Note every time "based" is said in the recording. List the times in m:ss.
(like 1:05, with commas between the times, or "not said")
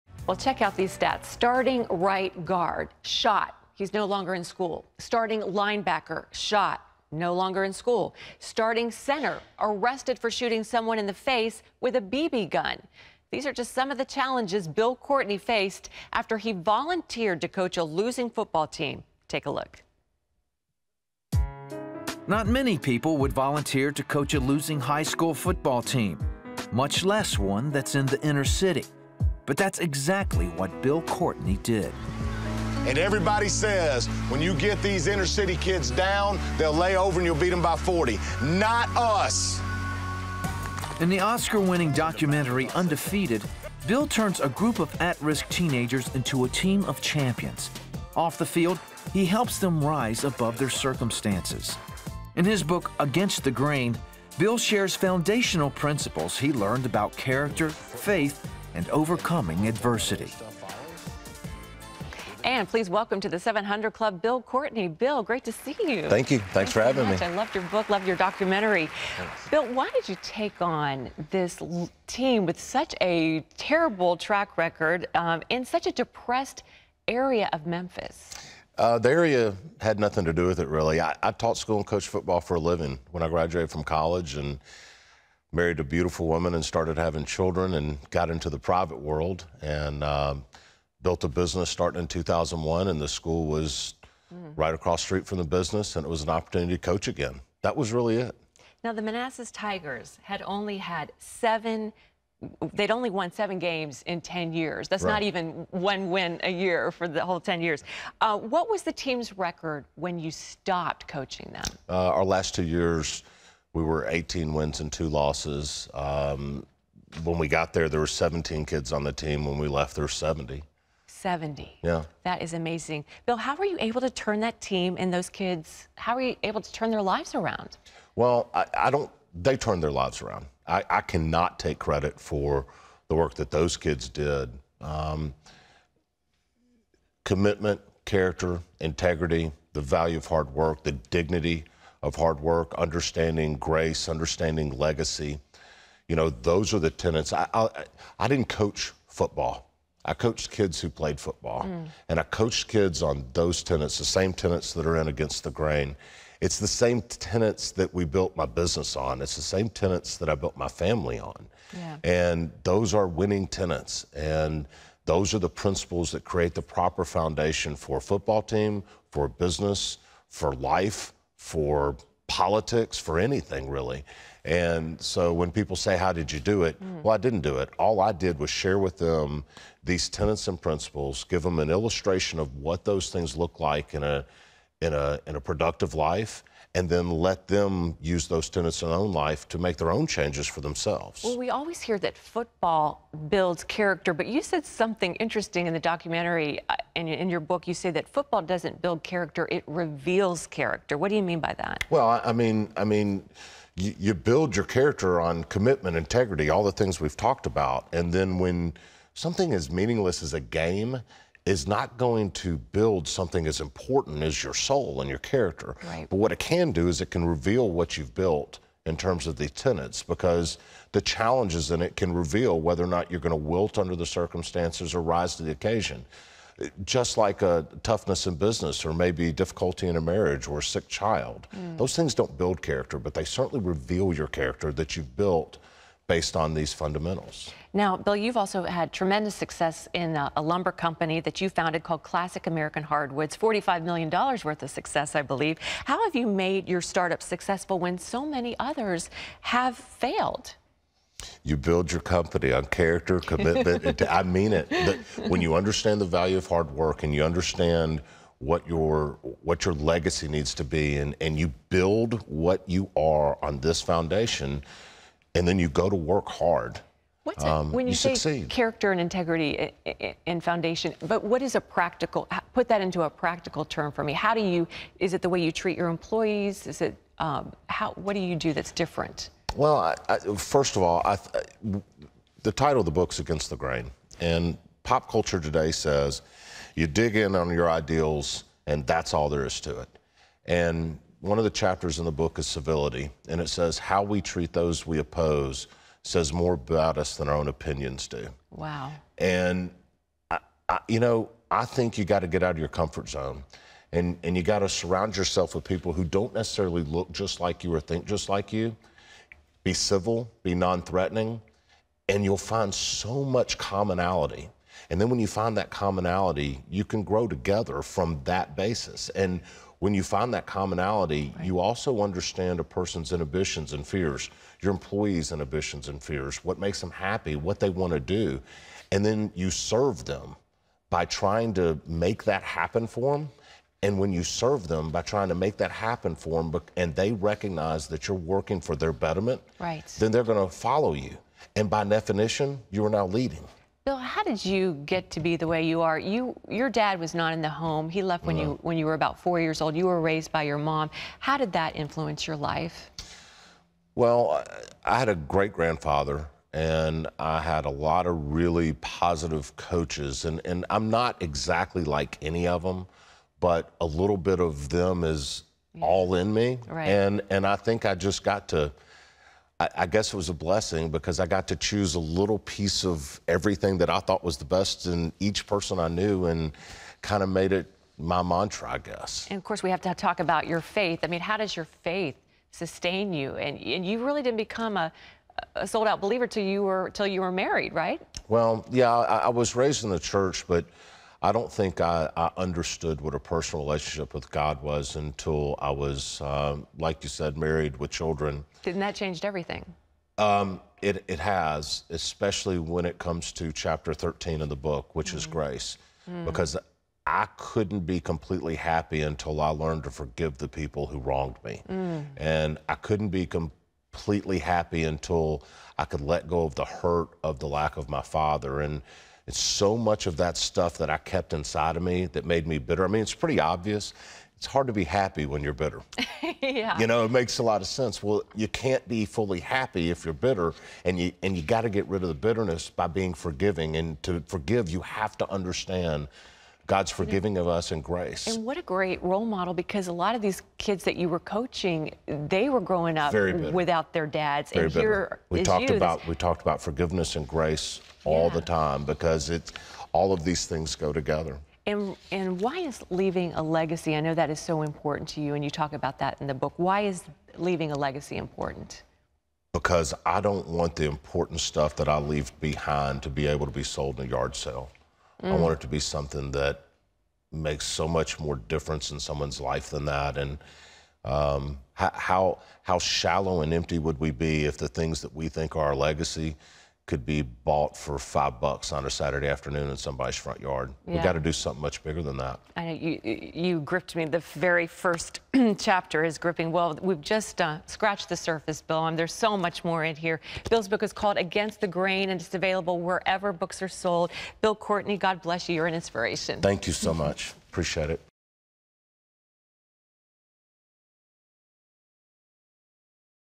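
3:56.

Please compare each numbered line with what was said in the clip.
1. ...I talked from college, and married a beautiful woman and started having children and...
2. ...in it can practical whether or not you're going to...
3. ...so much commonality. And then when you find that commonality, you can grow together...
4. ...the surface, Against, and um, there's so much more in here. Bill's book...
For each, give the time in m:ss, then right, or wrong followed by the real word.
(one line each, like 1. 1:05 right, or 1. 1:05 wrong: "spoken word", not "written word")
1. 1:23 wrong: "graduated", not "talked"
2. 3:41 wrong: "reveal", not "practical"
3. 5:12 right
4. 8:08 wrong: "Bill", not "Against".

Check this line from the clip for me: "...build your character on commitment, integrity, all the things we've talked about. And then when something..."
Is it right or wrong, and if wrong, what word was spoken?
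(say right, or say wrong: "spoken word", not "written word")
right.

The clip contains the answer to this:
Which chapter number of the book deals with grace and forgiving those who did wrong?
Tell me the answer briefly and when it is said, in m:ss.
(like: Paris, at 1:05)
13, at 6:43.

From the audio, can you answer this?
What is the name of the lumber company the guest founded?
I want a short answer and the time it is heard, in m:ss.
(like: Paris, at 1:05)
Classic American Hardwoods, at 4:02.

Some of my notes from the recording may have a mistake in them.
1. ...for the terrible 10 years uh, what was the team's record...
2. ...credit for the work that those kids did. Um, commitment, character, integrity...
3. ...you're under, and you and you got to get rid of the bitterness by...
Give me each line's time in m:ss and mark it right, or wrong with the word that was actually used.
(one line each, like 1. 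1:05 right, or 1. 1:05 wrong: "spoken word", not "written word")
1. 1:46 wrong: "whole", not "terrible"
2. 2:11 right
3. 7:10 wrong: "bitter", not "under".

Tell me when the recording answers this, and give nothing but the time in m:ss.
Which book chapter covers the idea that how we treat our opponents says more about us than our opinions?
4:52.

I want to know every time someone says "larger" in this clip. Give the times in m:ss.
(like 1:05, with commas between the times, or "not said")
not said.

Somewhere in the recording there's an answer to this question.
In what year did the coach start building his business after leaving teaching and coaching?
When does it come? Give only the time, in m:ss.
1:32.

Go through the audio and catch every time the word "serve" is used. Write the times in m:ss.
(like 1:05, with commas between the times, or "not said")
5:29, 5:34.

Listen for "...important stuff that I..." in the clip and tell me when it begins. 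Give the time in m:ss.
7:40.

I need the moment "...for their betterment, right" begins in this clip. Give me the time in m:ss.
5:38.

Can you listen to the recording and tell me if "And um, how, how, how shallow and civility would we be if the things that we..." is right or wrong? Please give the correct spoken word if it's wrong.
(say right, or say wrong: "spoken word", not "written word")
wrong: "empty", not "civility".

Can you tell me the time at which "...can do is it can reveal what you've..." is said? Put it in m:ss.
3:36.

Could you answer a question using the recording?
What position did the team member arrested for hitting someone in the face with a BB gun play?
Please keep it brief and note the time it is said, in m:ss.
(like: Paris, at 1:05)
Center, at 0:08.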